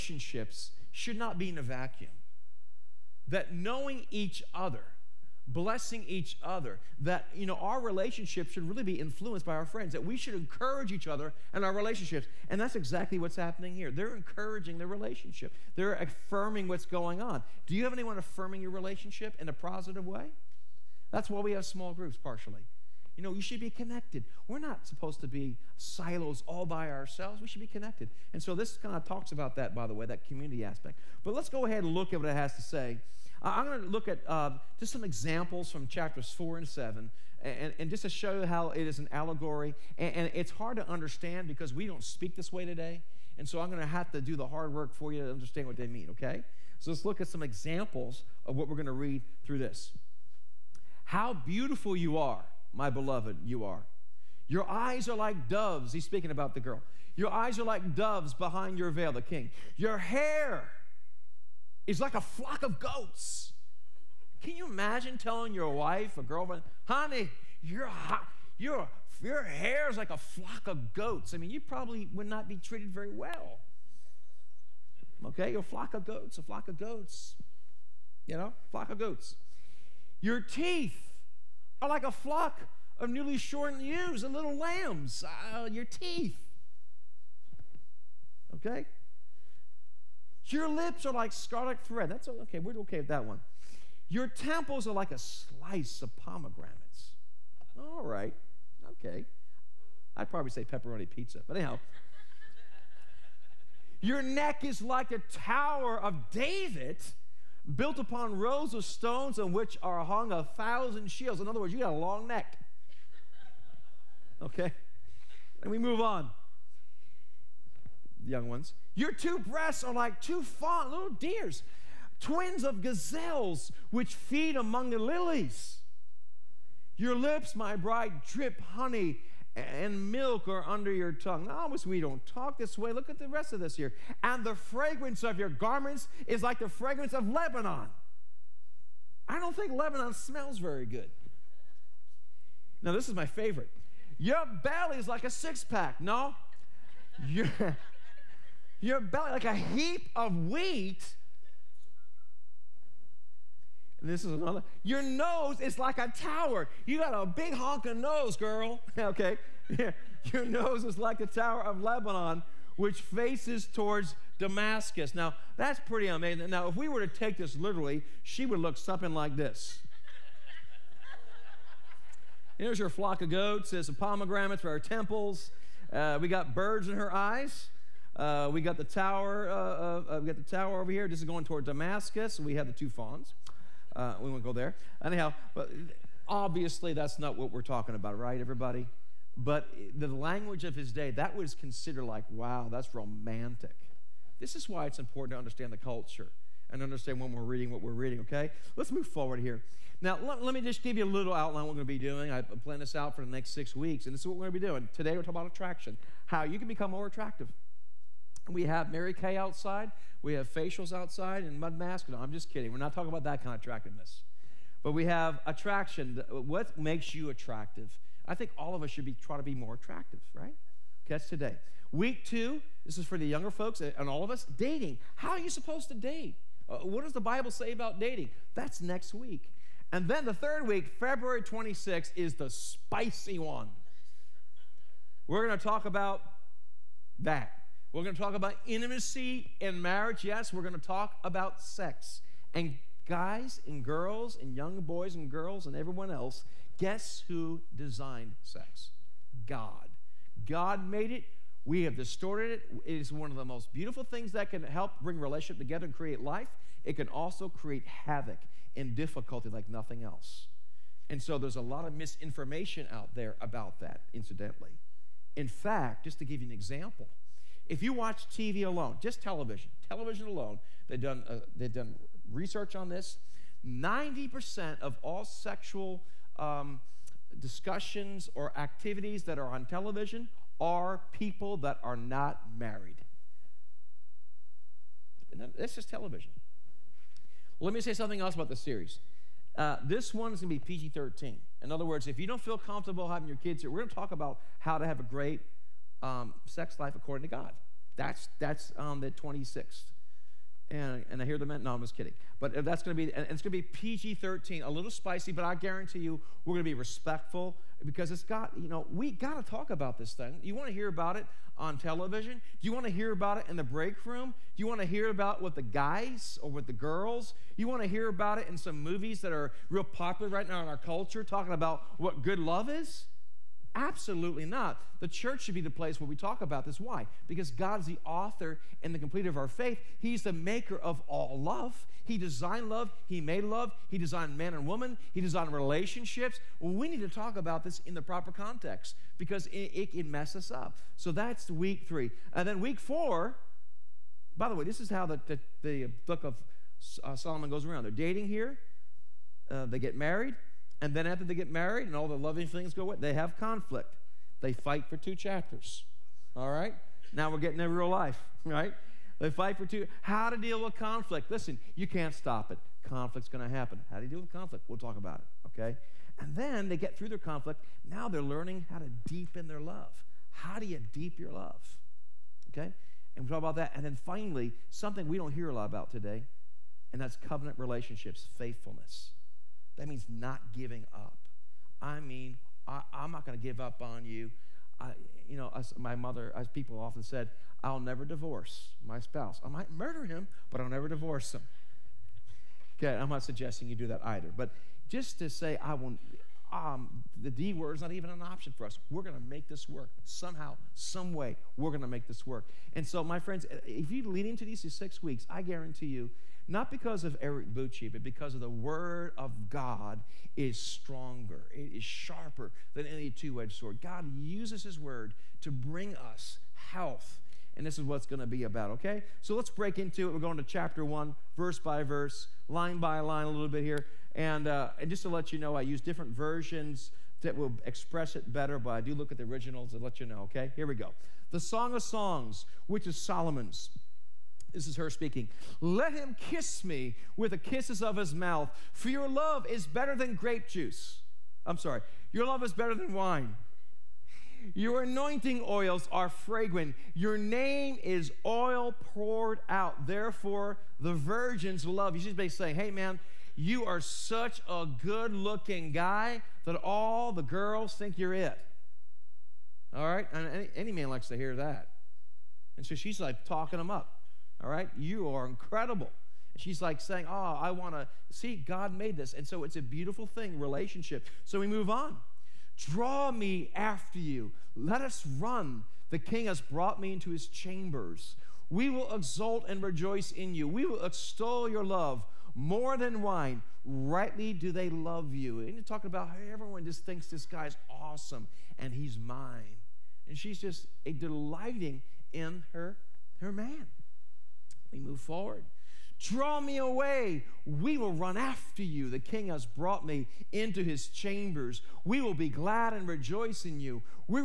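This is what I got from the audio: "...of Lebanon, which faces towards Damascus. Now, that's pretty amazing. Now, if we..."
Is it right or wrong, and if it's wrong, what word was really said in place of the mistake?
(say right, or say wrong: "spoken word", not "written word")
right.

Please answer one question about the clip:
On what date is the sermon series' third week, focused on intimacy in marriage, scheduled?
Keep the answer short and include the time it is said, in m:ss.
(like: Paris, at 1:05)
February 26th, at 3:50.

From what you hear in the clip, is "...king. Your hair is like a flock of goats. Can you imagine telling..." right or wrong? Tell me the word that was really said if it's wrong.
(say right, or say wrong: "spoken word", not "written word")
right.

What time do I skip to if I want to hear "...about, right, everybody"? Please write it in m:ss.
3:07.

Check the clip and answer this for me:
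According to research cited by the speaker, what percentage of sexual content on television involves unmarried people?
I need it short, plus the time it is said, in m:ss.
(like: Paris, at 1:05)
90%, at 4:33.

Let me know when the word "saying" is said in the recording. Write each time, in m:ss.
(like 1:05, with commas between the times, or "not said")
7:32, 7:46.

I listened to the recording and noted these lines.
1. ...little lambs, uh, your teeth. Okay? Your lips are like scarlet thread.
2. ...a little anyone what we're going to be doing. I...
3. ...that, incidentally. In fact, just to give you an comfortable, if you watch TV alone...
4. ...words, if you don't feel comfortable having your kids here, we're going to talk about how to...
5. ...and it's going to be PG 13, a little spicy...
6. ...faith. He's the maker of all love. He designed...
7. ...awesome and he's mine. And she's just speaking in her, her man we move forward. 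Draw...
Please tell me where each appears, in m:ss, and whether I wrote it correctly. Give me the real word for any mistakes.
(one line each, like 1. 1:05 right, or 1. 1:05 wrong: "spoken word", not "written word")
1. 1:24 right
2. 3:21 wrong: "outline", not "anyone"
3. 4:23 wrong: "example", not "comfortable"
4. 4:51 right
5. 5:03 right
6. 5:29 right
7. 8:07 wrong: "delighting", not "speaking".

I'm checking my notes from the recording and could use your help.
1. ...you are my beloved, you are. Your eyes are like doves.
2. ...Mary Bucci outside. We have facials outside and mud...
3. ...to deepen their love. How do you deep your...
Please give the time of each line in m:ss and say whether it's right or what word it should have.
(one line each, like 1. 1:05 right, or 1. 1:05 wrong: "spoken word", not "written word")
1. 0:51 right
2. 3:28 wrong: "Kay", not "Bucci"
3. 6:08 right.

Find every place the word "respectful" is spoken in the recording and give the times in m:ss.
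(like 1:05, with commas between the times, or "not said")
5:06.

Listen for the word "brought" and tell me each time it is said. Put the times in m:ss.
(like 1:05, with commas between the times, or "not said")
7:56, 8:19.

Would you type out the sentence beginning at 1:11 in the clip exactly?
I mean, you probably would not be treated very well.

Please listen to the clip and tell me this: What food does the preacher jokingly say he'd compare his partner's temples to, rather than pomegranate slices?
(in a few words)
Pepperoni pizza.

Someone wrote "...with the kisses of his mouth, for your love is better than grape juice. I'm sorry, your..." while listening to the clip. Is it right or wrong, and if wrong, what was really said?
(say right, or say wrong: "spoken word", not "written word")
right.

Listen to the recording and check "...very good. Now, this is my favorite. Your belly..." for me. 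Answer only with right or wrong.
right.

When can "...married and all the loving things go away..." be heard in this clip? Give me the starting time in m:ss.
5:51.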